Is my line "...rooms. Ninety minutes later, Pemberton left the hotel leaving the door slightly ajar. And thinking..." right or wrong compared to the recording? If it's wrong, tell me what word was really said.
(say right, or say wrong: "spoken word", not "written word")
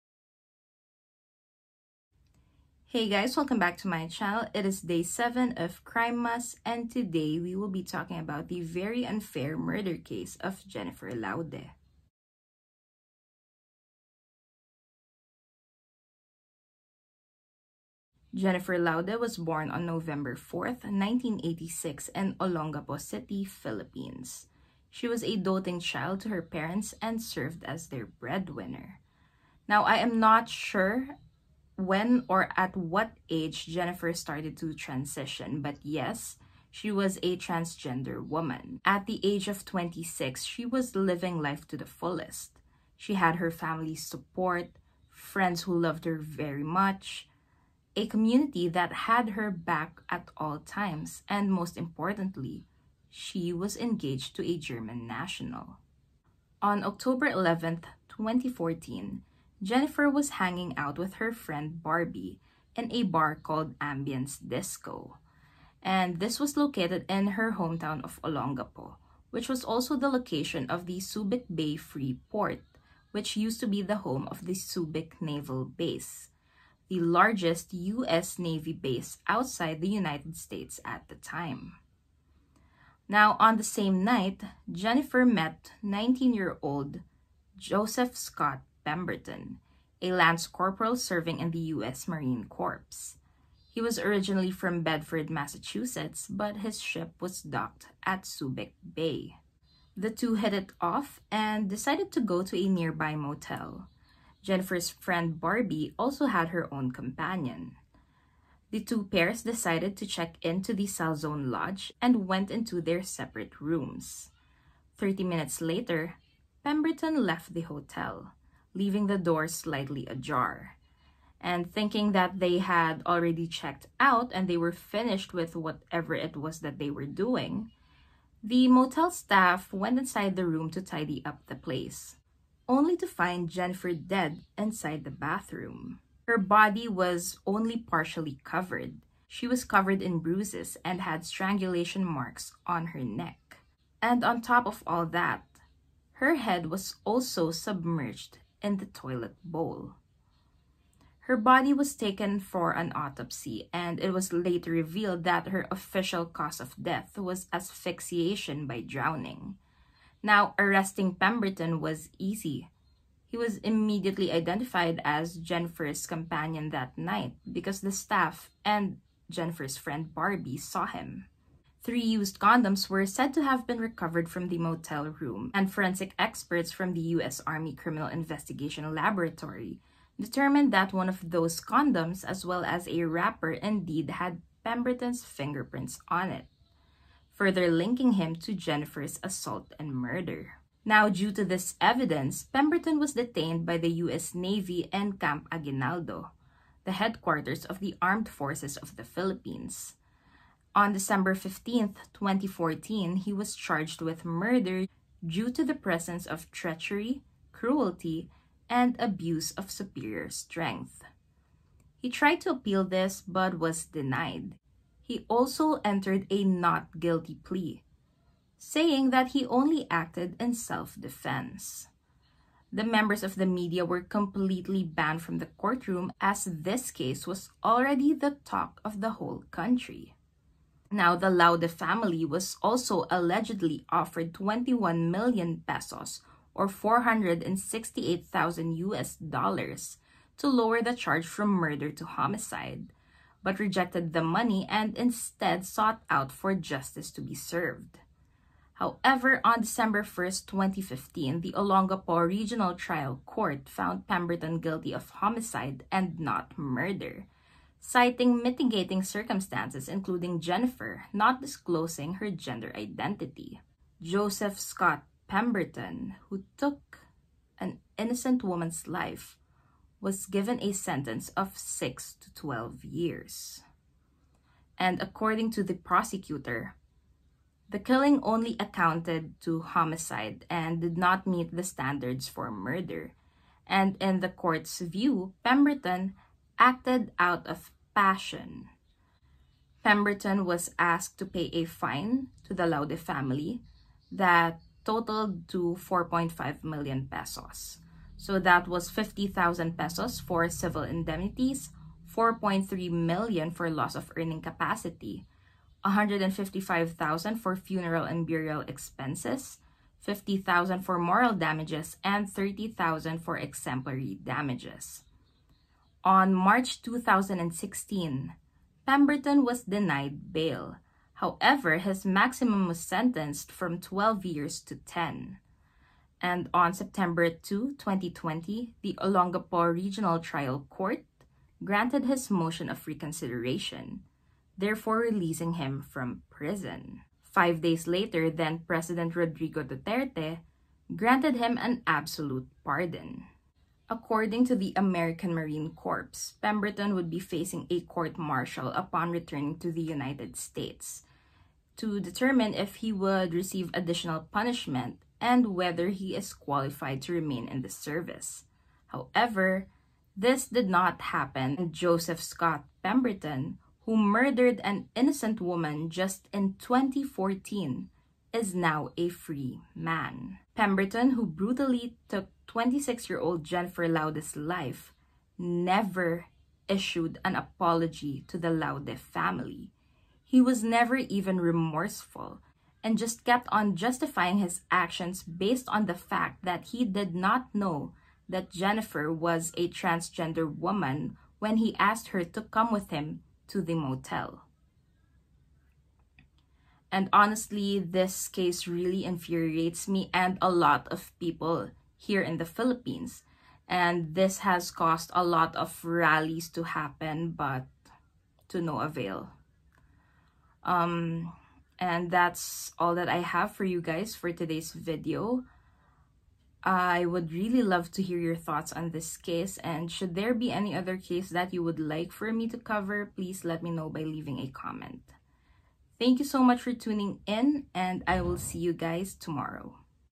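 wrong: "Thirty", not "Ninety".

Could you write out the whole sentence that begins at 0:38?
At the age of 26, she was living life to the fullest.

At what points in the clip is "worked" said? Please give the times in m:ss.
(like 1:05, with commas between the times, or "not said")
not said.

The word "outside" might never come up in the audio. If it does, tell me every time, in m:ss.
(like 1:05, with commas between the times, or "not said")
1:19.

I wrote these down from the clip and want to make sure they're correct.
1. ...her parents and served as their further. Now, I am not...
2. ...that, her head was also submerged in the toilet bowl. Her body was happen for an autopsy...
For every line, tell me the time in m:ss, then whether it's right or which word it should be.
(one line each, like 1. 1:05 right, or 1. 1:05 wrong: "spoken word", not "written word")
1. 0:26 wrong: "breadwinner", not "further"
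2. 2:25 wrong: "taken", not "happen".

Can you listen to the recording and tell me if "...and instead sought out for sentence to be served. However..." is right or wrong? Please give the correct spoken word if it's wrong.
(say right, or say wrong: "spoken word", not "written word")
wrong: "justice", not "sentence".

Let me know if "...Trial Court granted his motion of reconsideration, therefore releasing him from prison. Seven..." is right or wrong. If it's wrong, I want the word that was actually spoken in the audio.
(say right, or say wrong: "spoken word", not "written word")
wrong: "Five", not "Seven".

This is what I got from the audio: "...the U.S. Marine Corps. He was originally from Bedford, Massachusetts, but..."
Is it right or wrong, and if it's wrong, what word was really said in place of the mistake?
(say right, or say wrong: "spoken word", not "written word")
right.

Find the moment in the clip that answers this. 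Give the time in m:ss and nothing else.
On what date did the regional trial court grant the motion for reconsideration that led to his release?
5:26.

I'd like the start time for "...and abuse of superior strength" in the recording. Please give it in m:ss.
3:28.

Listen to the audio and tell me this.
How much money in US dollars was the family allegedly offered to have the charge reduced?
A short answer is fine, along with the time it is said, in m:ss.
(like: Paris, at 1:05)
$468,000, at 3:56.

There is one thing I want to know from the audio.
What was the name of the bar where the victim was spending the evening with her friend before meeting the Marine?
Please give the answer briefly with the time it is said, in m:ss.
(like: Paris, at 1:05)
Ambyanz Disco, at 1:03.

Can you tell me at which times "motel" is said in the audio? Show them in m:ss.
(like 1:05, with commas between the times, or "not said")
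1:43, 2:08, 2:54, 6:33.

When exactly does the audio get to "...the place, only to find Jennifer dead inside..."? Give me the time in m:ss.
2:11.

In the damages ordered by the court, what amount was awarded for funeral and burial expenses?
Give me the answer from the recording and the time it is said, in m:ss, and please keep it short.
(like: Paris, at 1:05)
155,000 pesos, at 5:05.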